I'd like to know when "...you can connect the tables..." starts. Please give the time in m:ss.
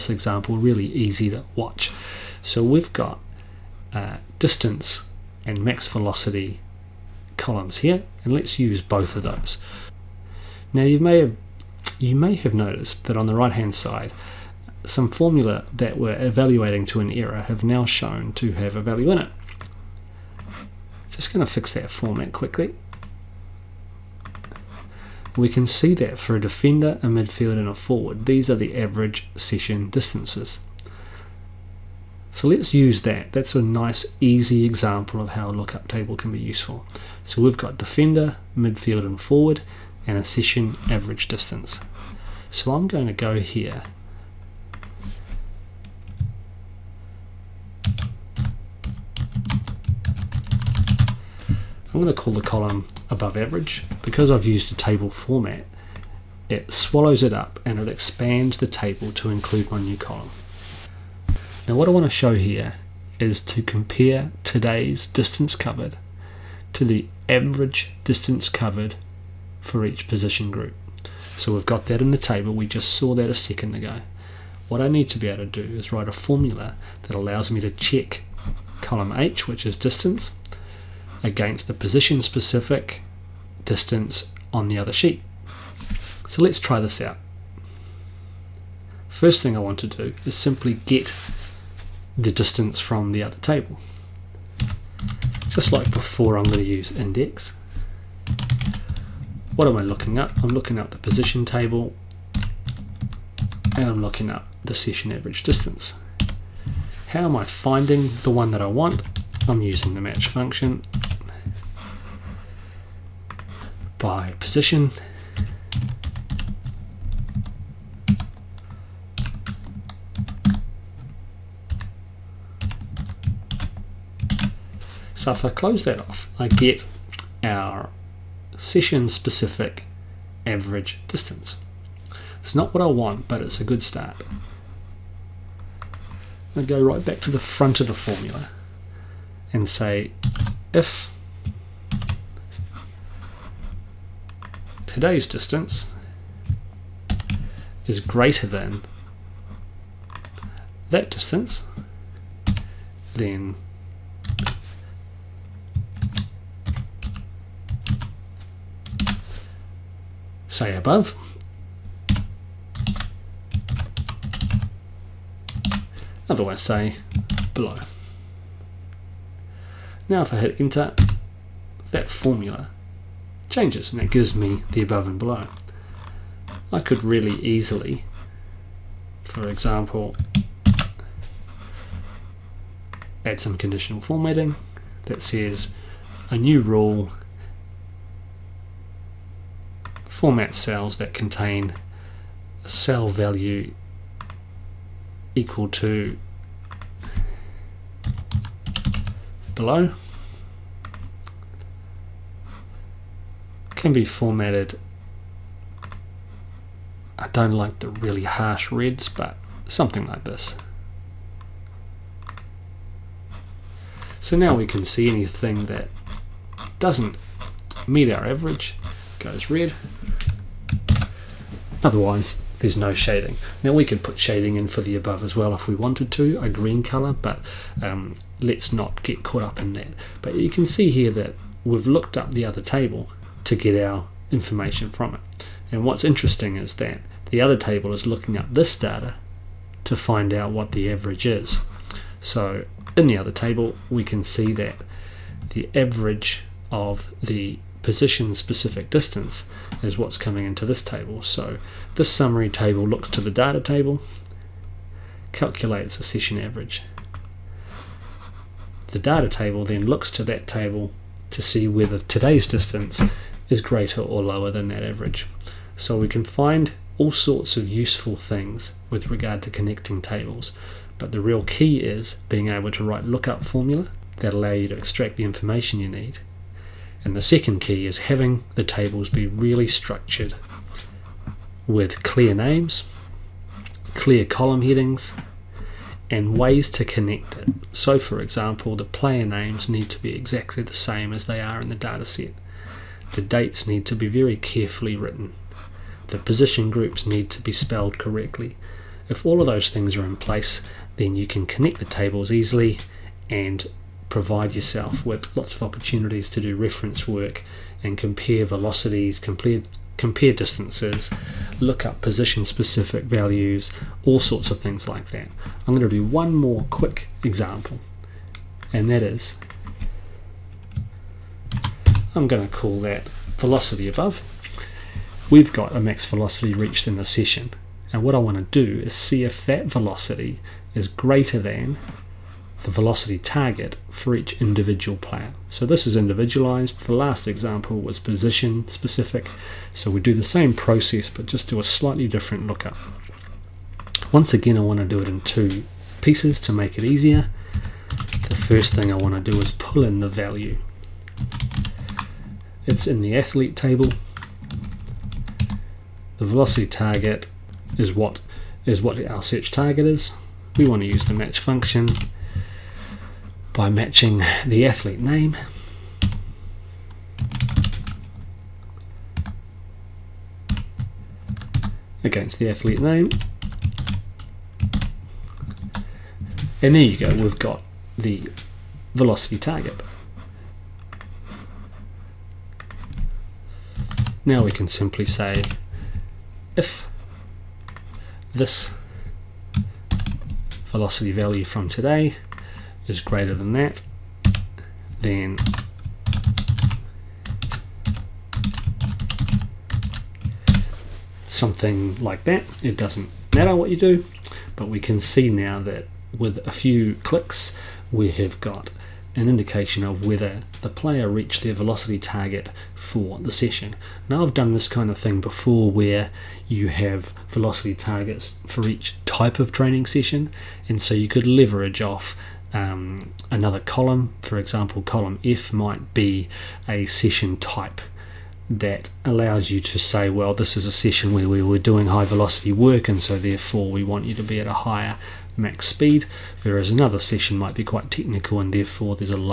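5:01.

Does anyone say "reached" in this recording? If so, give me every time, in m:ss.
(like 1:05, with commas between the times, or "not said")
5:26, 6:51.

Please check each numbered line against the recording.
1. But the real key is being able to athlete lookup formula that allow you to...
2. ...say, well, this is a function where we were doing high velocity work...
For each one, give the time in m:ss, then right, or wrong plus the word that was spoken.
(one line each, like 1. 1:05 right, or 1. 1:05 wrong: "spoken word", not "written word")
1. 4:30 wrong: "write", not "athlete"
2. 7:09 wrong: "session", not "function".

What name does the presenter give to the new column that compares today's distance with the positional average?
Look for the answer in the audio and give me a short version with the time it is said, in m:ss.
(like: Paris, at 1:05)
above average, at 0:53.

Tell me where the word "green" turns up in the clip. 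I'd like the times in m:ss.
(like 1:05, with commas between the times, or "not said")
3:46.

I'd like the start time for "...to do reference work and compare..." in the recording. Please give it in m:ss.
5:06.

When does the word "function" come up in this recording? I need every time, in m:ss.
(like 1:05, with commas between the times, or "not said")
1:50, 6:01.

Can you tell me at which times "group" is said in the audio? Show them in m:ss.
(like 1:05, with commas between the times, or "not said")
1:10, 4:56.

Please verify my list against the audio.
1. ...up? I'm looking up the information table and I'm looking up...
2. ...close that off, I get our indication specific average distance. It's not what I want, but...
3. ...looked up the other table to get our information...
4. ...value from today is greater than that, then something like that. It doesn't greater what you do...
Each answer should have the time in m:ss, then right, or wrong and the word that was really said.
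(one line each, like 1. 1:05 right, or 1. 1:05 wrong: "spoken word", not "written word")
1. 1:40 wrong: "position", not "information"
2. 2:05 wrong: "session", not "indication"
3. 3:51 right
4. 6:31 wrong: "matter", not "greater".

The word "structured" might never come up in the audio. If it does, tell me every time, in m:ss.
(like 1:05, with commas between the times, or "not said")
4:39.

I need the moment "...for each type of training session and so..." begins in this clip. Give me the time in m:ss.
6:58.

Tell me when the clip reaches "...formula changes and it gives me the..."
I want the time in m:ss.
2:52.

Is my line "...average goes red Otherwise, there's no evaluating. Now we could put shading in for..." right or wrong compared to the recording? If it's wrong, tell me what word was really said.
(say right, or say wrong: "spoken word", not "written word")
wrong: "shading", not "evaluating".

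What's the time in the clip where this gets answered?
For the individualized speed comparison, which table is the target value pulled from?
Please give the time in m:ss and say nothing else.
5:53.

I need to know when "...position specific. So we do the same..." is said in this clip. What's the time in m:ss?
5:38.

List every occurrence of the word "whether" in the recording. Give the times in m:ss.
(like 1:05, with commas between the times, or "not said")
4:21, 6:50.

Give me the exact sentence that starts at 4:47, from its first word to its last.
So for example, the player names need to be exactly the same as they are in the dataset.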